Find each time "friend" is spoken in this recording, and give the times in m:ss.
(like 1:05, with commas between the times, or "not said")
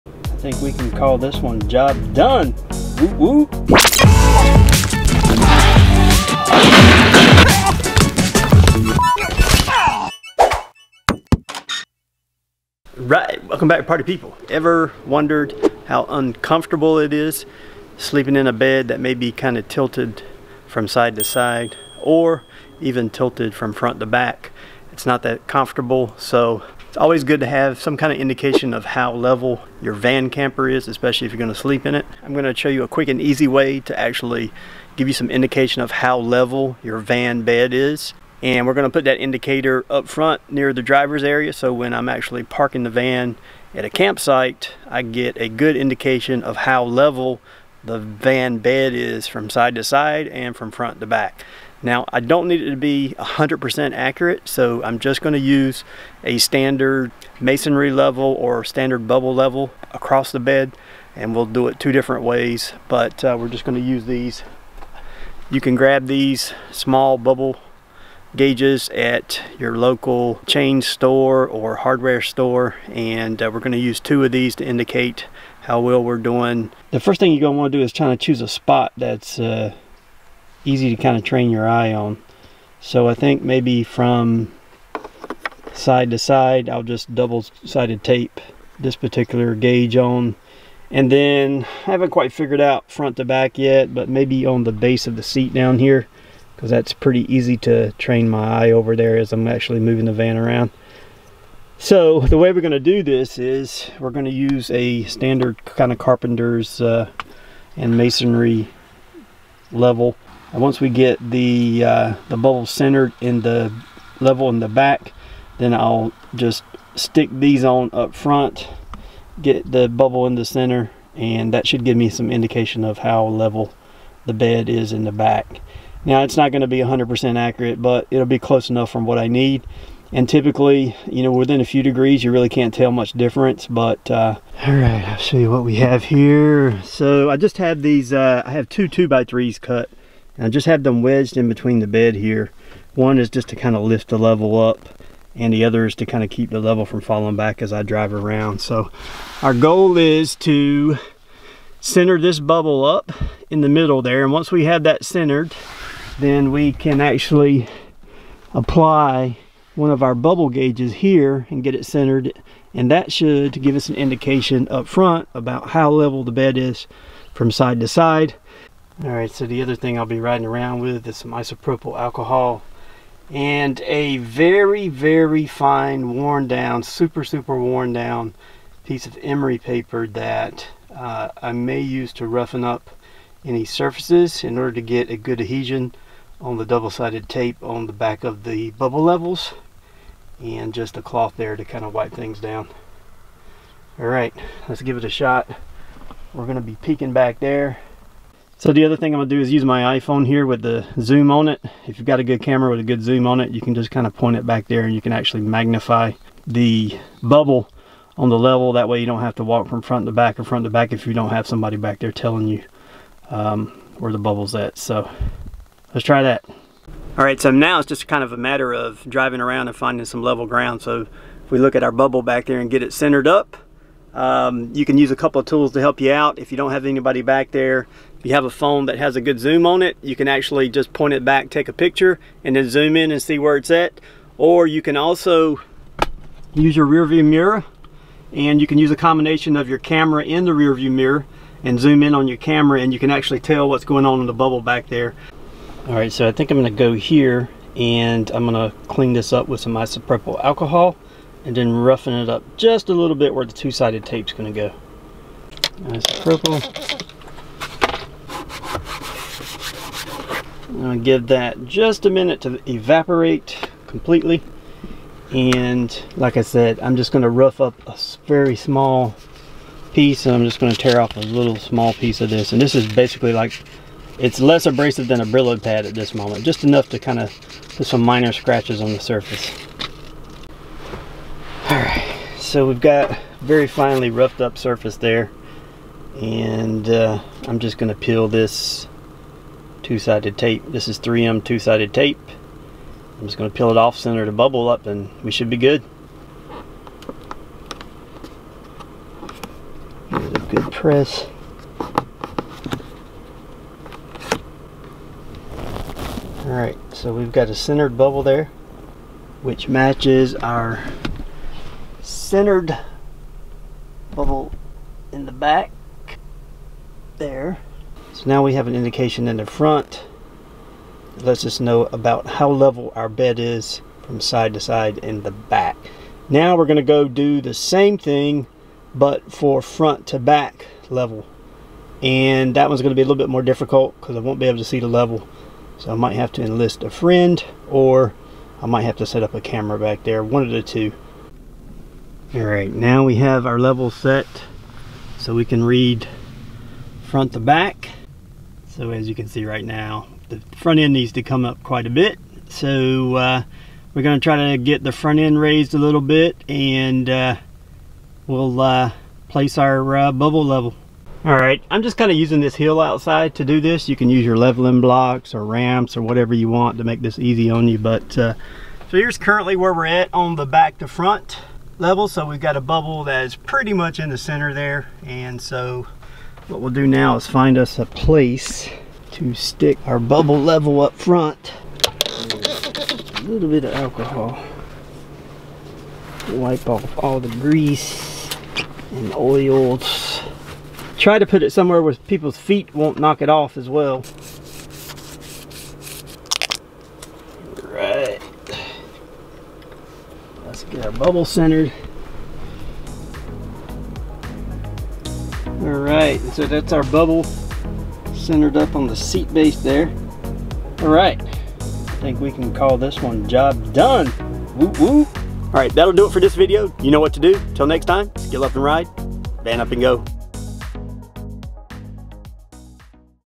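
5:36.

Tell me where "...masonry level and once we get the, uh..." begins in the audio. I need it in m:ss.
1:47.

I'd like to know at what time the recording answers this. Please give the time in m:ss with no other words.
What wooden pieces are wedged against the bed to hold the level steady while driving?
2:18.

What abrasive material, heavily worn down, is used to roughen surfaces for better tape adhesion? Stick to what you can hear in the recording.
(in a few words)
emery paper.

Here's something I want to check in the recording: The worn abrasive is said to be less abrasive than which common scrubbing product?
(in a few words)
Brillo pad.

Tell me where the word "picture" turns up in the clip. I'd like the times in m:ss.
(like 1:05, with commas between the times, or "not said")
3:51.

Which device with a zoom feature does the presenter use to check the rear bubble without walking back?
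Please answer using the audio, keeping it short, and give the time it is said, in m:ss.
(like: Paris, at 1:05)
iPhone, at 3:19.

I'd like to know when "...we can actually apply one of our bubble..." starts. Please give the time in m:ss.
2:36.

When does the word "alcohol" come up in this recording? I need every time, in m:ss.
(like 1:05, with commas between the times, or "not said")
2:51, 4:10, 6:23.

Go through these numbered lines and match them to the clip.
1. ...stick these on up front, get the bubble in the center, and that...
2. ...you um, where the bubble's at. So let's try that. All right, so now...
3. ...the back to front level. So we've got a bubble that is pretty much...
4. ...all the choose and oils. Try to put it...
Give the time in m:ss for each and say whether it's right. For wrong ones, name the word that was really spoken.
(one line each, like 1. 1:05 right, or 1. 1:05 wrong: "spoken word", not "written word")
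1. 1:56 right
2. 3:32 right
3. 6:10 right
4. 6:26 wrong: "grease", not "choose".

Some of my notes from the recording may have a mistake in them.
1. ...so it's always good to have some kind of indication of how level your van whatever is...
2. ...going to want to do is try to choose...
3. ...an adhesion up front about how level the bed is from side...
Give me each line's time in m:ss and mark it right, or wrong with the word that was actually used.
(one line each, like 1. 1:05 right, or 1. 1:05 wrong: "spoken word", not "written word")
1. 0:26 wrong: "camper", not "whatever"
2. 1:17 right
3. 2:43 wrong: "indication", not "adhesion".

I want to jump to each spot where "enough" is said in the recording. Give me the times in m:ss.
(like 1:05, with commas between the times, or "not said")
2:08, 4:36.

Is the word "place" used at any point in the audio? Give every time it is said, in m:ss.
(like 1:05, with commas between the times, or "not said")
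5:59, 6:17.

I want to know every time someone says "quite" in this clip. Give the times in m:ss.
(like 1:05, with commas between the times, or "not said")
1:32, 5:51.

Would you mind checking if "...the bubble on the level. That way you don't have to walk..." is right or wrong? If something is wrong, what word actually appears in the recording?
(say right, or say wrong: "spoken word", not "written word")
right.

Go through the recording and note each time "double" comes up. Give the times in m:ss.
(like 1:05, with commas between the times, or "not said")
1:27, 3:06.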